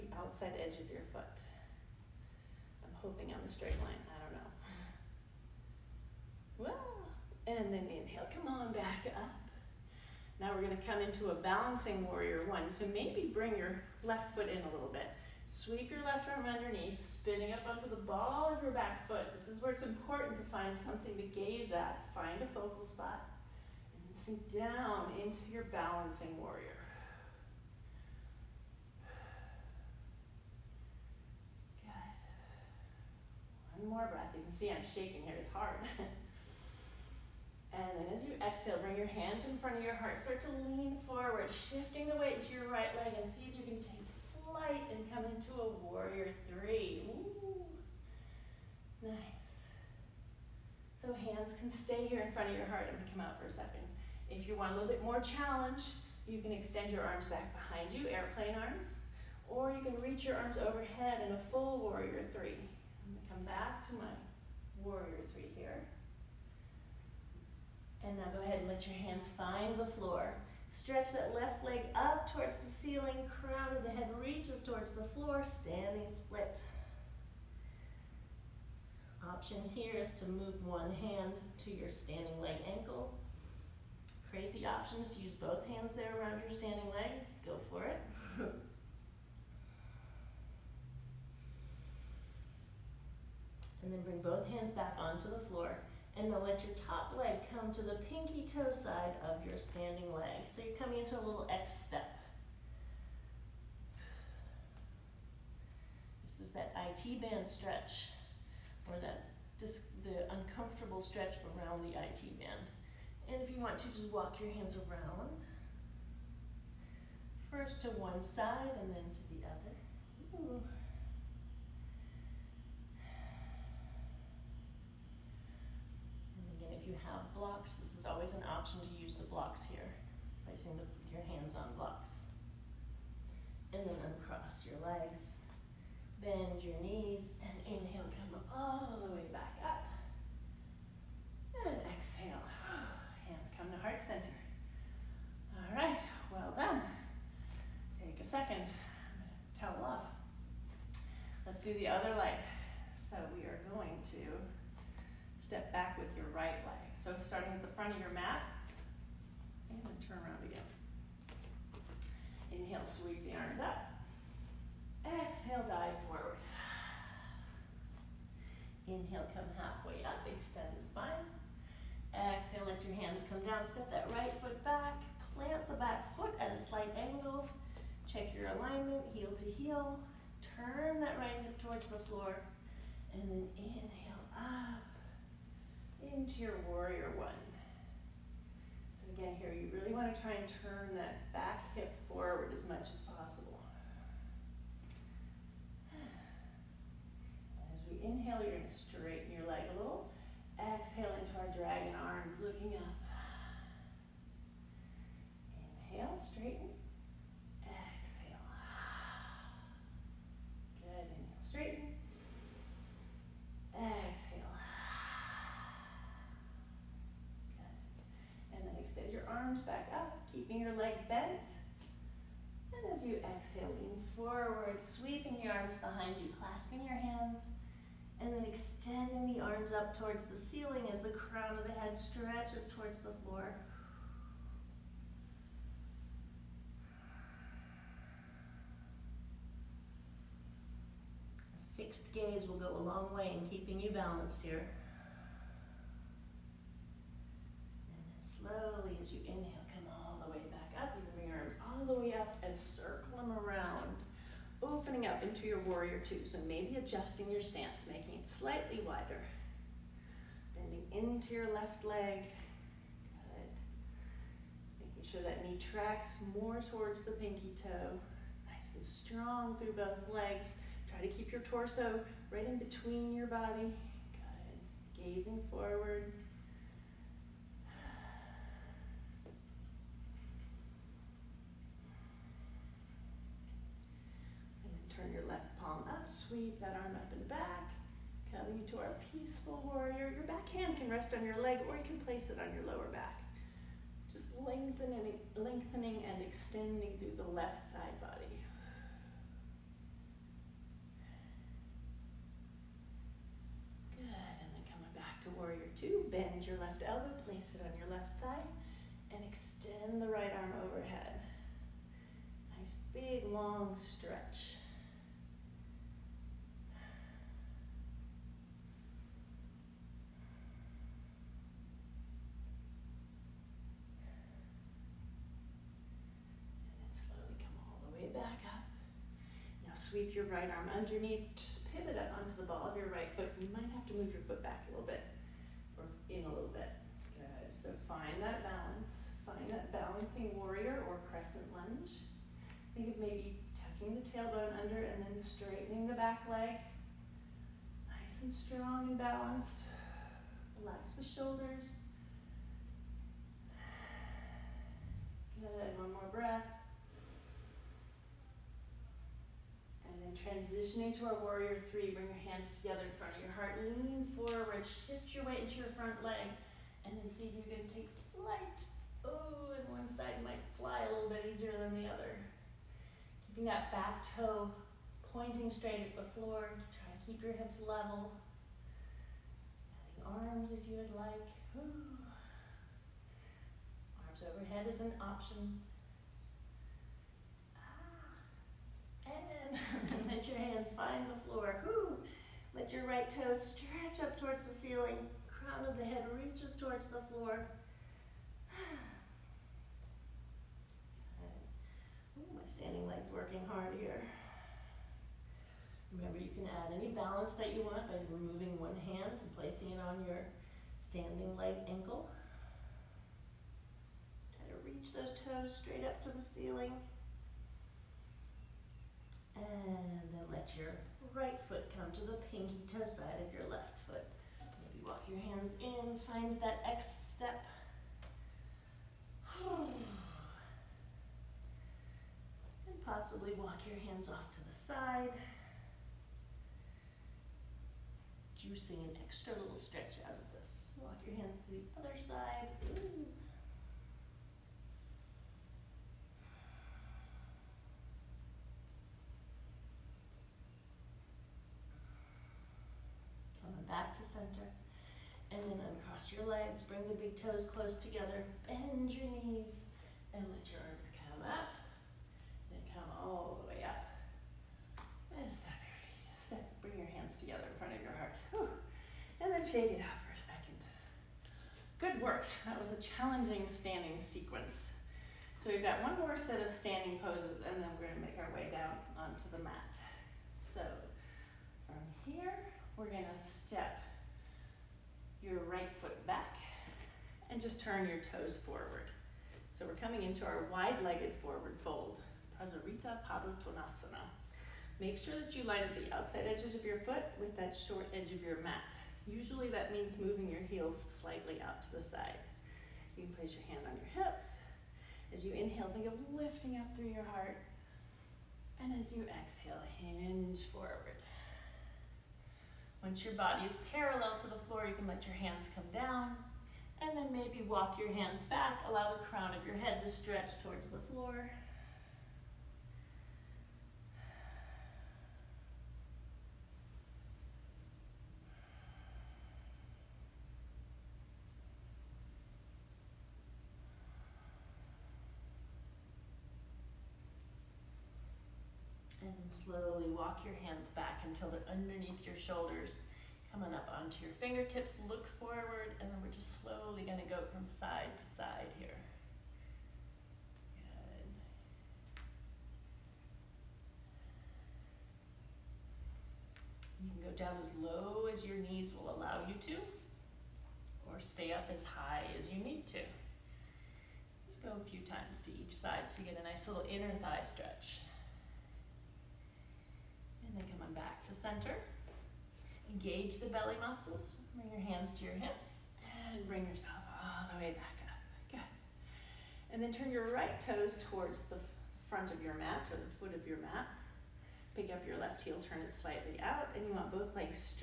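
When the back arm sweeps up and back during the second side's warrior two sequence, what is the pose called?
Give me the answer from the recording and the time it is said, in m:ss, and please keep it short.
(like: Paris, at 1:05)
Peaceful warrior, at 4:49.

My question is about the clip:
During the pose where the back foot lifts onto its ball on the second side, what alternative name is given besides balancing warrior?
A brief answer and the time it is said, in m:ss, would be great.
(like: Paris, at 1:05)
Crescent lunge, at 5:41.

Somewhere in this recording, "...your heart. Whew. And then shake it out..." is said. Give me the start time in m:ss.
7:47.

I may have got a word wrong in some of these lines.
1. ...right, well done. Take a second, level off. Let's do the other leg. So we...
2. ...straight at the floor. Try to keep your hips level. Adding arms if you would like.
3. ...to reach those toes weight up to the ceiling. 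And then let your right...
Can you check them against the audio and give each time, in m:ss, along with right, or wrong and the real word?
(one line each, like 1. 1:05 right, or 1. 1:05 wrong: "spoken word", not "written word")
1. 2:25 wrong: "towel", not "level"
2. 6:15 right
3. 6:54 wrong: "straight", not "weight".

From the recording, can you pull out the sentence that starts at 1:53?
And if you want to, just walk your hands around.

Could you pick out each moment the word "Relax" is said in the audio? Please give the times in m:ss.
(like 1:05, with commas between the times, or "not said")
5:50.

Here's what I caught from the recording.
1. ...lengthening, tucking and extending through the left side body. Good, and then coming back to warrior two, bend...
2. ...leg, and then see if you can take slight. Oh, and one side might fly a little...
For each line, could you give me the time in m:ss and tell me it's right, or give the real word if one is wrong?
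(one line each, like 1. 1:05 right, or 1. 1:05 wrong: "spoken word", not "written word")
1. 4:54 wrong: "lengthening", not "tucking"
2. 6:06 wrong: "flight", not "slight".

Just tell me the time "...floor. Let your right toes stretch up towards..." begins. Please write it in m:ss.
6:31.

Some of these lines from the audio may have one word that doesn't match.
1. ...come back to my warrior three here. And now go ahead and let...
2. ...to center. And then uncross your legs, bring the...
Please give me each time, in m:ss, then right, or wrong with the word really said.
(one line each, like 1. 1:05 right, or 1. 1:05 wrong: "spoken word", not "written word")
1. 1:03 right
2. 7:33 right.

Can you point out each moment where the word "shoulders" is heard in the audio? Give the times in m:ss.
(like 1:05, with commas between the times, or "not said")
5:51, 9:02.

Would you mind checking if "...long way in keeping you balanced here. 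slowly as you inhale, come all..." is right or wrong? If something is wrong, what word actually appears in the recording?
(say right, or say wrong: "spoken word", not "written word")
right.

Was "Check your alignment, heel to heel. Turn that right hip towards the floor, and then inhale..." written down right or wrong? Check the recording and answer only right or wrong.
right.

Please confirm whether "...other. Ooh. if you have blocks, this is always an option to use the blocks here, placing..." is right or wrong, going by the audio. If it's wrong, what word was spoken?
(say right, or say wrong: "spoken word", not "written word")
right.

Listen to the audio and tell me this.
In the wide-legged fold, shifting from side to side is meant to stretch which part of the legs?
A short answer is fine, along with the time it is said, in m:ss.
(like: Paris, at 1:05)
Inner thigh, at 9:26.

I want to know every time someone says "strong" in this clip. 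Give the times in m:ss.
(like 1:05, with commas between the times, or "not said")
4:28, 5:48.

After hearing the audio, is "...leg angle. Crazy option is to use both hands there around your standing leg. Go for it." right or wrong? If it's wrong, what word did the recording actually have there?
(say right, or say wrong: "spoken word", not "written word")
wrong: "ankle", not "angle".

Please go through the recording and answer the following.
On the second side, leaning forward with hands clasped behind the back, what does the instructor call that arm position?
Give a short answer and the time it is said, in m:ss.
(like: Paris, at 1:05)
Dragon arms, at 3:21.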